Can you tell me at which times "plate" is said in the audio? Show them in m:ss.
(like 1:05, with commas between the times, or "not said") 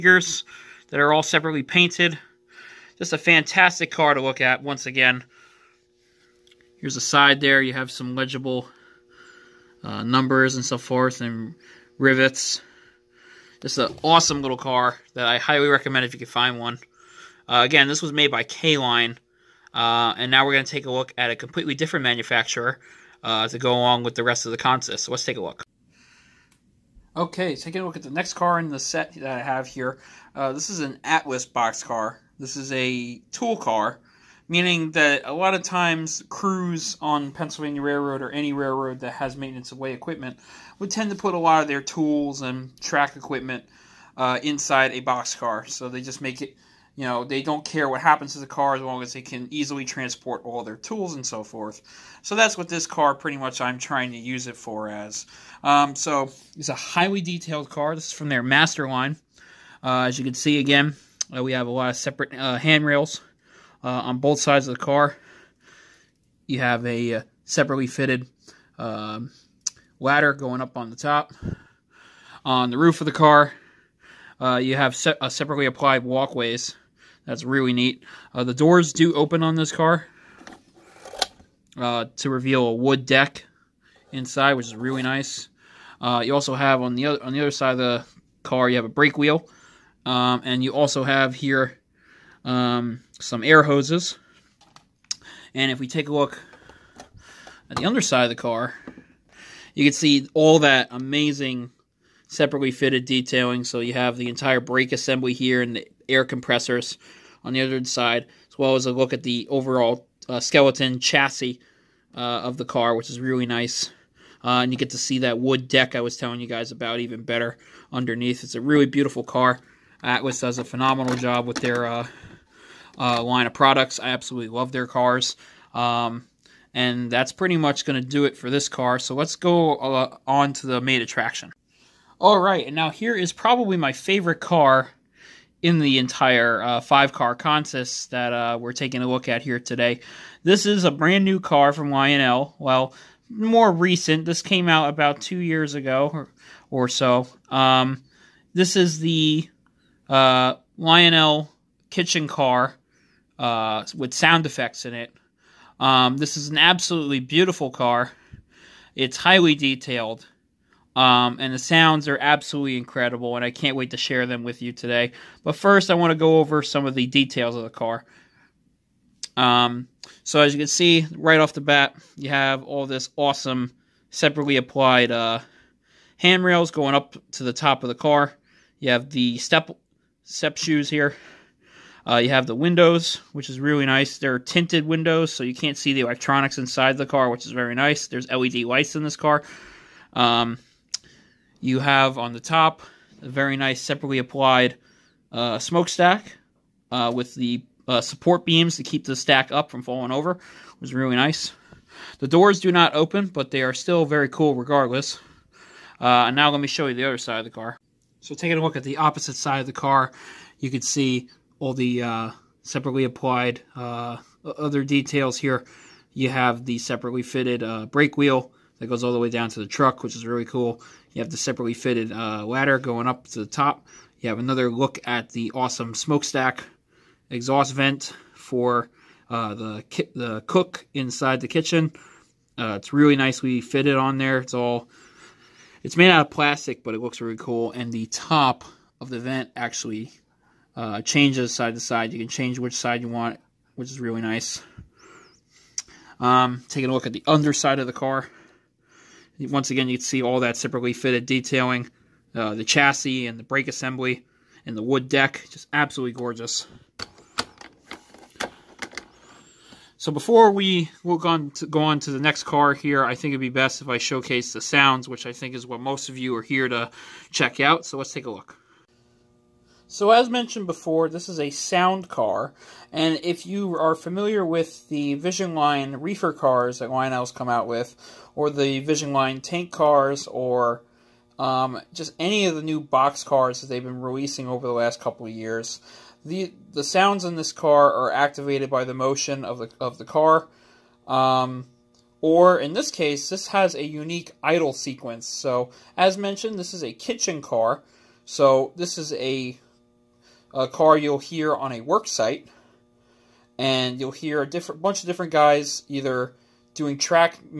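not said.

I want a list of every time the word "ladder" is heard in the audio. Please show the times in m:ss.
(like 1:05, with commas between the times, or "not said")
1:09, 3:42.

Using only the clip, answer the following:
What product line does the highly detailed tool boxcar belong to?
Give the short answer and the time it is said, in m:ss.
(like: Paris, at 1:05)
Master line, at 0:58.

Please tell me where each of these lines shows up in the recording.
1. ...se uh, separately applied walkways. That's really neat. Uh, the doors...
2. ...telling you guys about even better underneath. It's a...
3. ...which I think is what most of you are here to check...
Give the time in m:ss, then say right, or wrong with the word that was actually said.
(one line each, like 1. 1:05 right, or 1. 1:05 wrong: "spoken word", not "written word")
1. 1:14 right
2. 1:56 right
3. 4:25 right.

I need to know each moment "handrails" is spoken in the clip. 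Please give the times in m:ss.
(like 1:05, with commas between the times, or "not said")
1:02, 2:56.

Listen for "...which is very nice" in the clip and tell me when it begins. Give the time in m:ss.
3:07.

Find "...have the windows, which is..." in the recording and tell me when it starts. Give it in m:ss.
3:02.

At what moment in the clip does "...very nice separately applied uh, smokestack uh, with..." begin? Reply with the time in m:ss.
3:13.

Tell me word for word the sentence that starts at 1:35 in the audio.
And if we take a look at the underside of the car, you can see all that amazing separately fitted detailing.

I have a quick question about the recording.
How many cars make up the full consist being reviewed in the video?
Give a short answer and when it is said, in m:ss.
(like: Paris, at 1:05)
5, at 2:16.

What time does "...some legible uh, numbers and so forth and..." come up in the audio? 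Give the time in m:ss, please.
0:07.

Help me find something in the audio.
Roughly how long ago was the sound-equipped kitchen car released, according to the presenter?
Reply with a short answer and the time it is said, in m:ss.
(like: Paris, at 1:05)
About 2 years, at 2:24.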